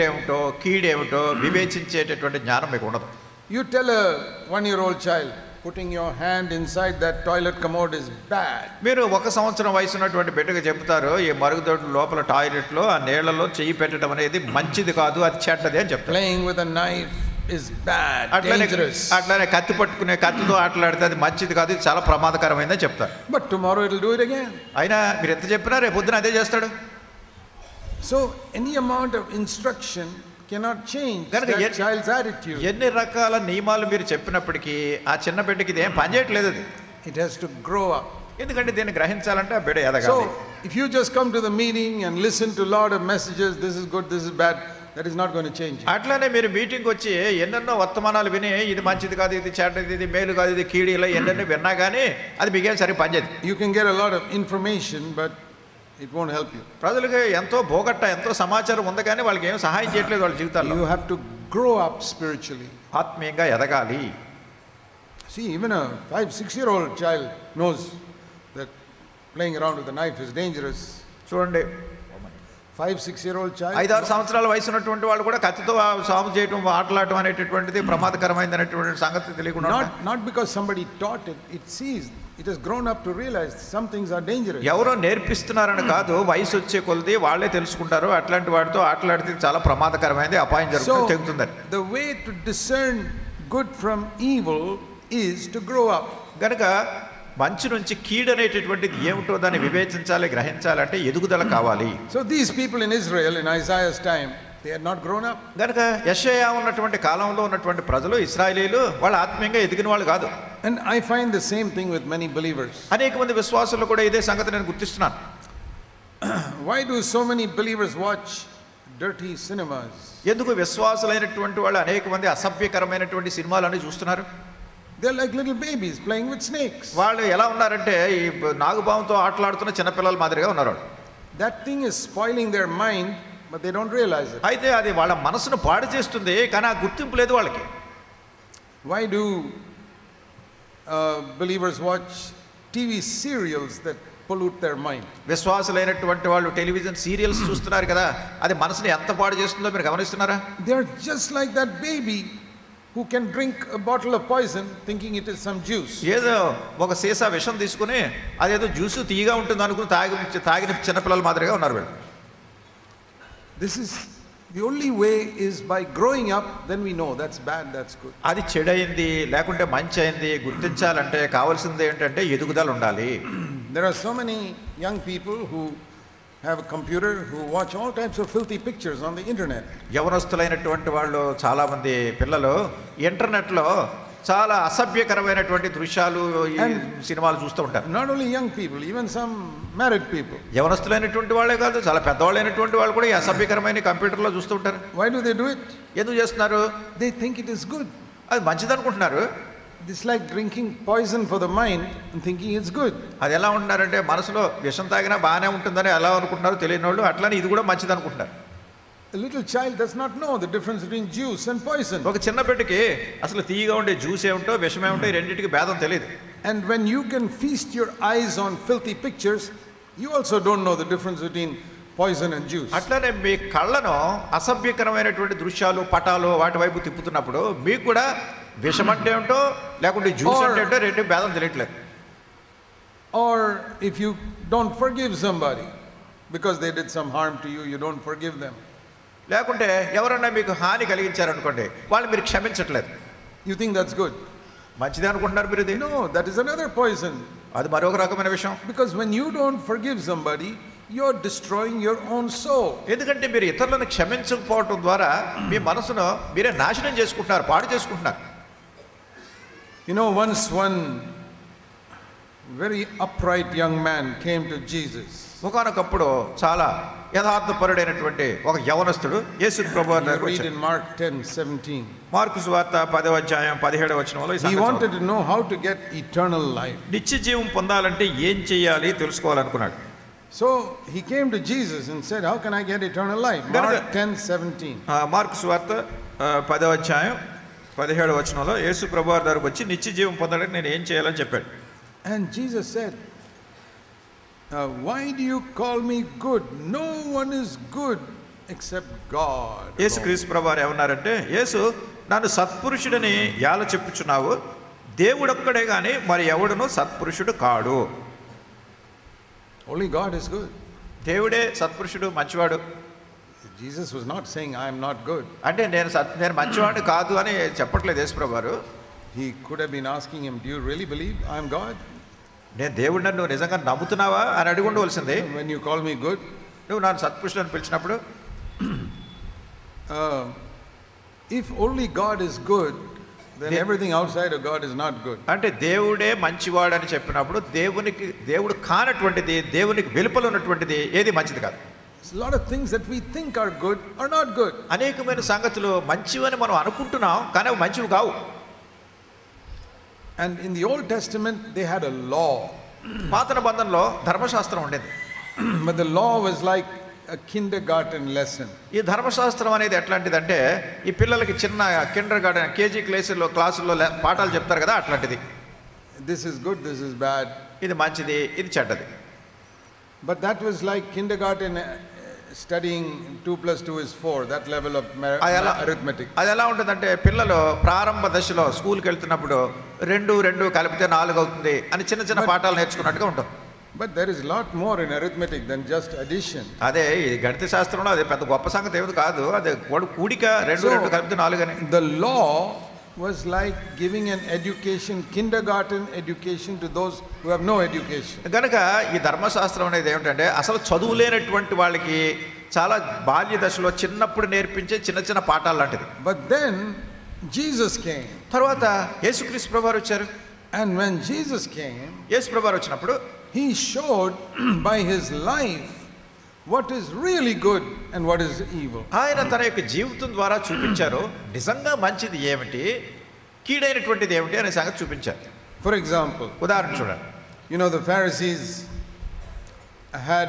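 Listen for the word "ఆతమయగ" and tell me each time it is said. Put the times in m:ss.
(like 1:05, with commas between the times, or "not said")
1:03, 1:49.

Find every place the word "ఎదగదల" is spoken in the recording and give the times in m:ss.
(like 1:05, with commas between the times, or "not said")
1:41, 2:52.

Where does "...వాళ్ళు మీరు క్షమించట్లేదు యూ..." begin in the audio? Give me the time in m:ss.
4:01.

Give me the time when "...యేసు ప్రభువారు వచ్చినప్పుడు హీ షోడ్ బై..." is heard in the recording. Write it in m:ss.
6:52.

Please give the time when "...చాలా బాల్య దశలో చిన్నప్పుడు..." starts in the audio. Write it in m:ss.
6:42.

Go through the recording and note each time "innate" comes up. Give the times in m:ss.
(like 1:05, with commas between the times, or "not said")
not said.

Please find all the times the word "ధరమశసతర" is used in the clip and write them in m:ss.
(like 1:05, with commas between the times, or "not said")
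5:54, 5:58, 6:39.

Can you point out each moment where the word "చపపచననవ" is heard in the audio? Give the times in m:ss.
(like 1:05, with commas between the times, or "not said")
5:03.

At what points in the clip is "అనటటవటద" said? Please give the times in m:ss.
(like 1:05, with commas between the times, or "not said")
1:17, 1:38.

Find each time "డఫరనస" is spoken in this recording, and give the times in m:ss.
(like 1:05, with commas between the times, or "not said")
3:30, 3:40.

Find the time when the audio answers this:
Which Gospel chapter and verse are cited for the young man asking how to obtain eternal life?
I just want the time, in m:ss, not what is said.
4:43.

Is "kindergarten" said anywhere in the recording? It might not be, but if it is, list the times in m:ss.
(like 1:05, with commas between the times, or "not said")
5:57, 6:01, 6:10, 6:35.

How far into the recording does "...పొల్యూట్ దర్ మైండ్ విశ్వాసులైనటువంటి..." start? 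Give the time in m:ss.
2:24.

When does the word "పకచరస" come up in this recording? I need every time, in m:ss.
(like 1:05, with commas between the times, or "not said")
2:58, 3:39.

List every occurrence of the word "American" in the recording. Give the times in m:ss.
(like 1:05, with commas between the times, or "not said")
not said.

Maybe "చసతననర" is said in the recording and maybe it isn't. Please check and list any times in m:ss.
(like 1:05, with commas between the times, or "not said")
2:03, 2:27, 3:16.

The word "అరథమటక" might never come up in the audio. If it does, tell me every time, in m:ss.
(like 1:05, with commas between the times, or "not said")
6:15, 6:24.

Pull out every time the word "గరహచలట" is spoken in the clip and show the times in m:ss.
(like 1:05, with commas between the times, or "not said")
0:38, 1:40.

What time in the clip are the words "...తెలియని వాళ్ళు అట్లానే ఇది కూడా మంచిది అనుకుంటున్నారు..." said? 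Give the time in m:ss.
3:26.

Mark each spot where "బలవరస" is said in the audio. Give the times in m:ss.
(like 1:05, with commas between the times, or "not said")
1:52, 1:57, 2:21.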